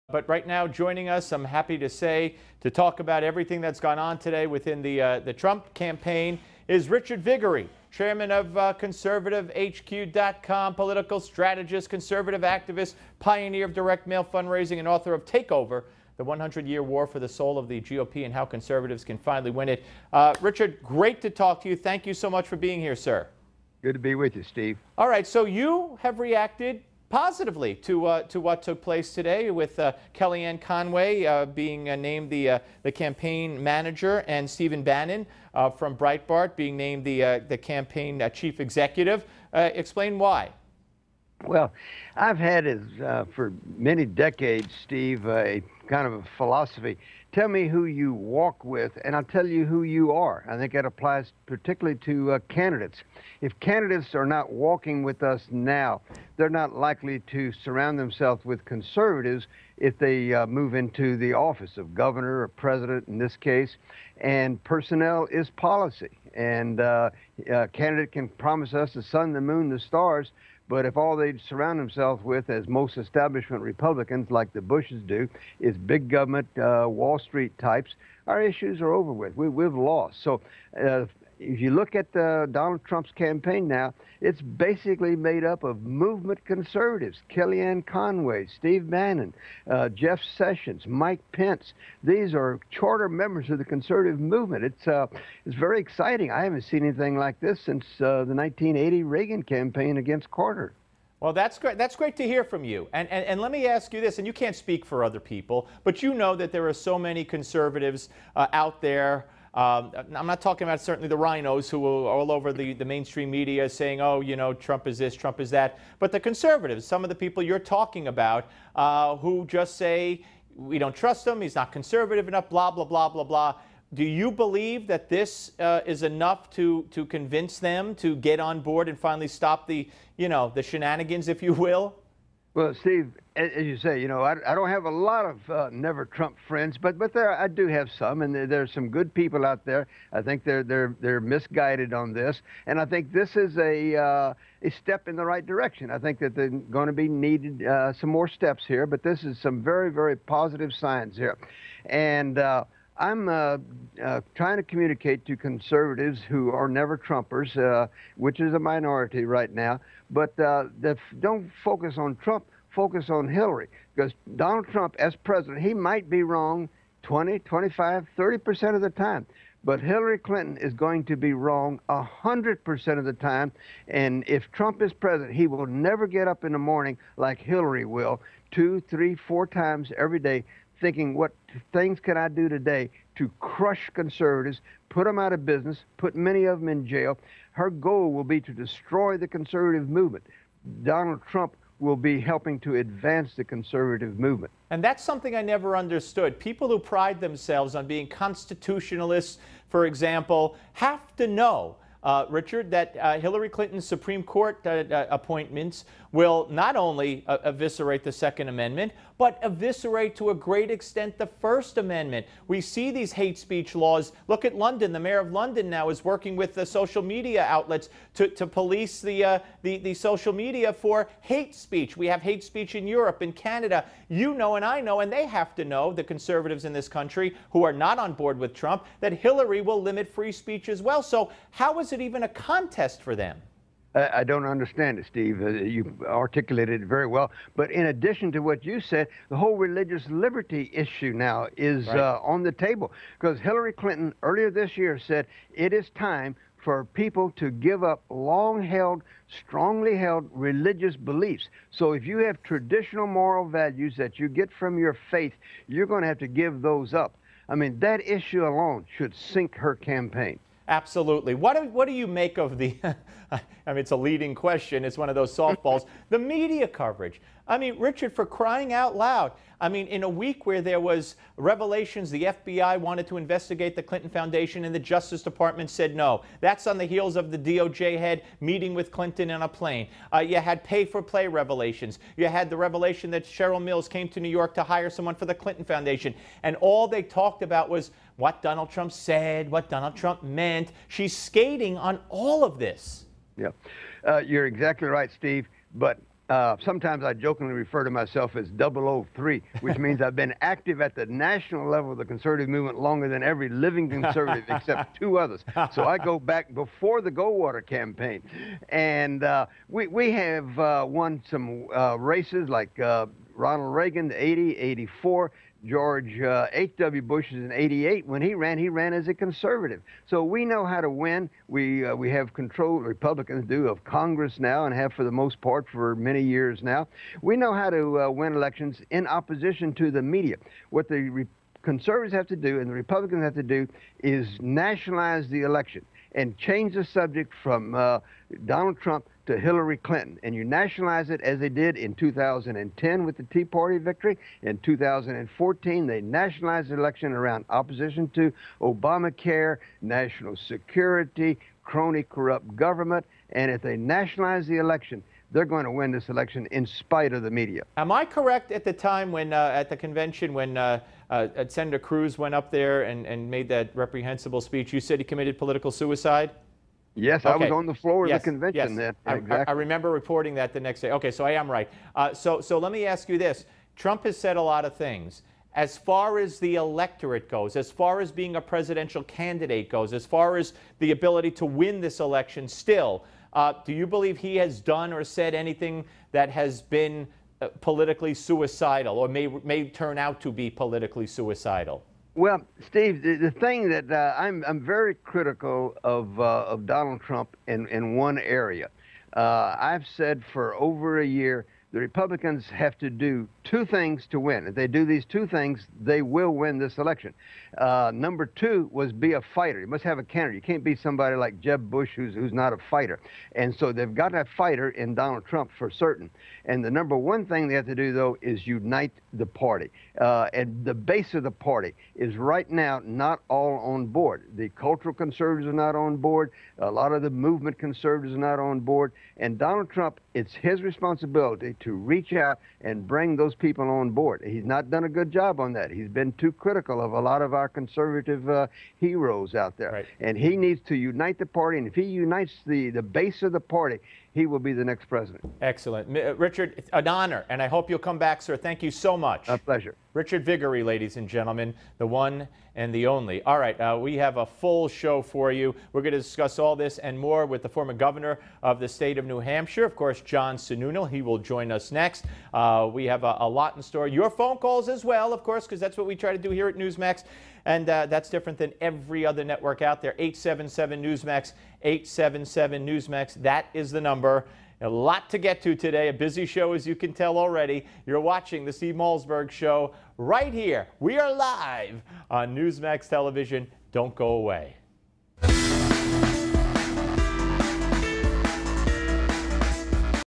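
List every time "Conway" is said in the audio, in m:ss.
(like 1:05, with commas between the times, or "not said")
0:30, 1:27.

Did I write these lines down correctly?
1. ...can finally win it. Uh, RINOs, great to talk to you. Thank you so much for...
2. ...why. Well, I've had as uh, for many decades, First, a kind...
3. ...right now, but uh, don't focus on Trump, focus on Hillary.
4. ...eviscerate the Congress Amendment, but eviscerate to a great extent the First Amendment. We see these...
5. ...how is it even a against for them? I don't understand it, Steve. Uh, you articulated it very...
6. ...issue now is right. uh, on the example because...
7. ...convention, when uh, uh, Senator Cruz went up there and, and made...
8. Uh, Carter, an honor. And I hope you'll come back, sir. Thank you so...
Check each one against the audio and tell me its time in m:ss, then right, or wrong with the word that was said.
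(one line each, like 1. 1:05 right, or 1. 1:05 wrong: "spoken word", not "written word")
1. 0:19 wrong: "Richard", not "RINOs"
2. 0:40 wrong: "Steve", not "First"
3. 2:39 right
4. 3:27 wrong: "Second", not "Congress"
5. 3:51 wrong: "contest", not "against"
6. 4:00 wrong: "table", not "example"
7. 5:59 right
8. 7:25 wrong: "Richard", not "Carter".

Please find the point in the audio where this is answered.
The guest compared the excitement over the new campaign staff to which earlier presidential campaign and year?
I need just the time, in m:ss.
1:38.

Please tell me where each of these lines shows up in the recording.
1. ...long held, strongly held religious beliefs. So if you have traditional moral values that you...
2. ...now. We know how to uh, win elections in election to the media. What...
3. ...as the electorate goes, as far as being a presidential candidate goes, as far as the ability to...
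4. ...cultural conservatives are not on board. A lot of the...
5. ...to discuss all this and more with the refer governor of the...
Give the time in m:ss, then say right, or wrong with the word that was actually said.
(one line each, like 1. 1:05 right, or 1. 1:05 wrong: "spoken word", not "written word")
1. 4:08 right
2. 5:26 wrong: "opposition", not "election"
3. 6:16 right
4. 7:04 right
5. 7:35 wrong: "former", not "refer".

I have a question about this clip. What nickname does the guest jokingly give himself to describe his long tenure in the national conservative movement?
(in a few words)
003.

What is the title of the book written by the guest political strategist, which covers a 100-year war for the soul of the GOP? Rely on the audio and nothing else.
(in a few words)
Takeover.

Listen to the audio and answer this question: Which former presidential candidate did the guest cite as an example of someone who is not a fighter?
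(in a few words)
Jeb Bush.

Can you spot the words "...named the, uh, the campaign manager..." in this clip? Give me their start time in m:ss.
0:31.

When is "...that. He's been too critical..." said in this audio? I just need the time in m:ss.
7:15.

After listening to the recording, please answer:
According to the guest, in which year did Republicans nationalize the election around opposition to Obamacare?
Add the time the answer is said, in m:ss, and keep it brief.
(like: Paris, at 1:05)
2014, at 5:44.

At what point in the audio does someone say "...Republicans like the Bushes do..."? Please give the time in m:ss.
1:13.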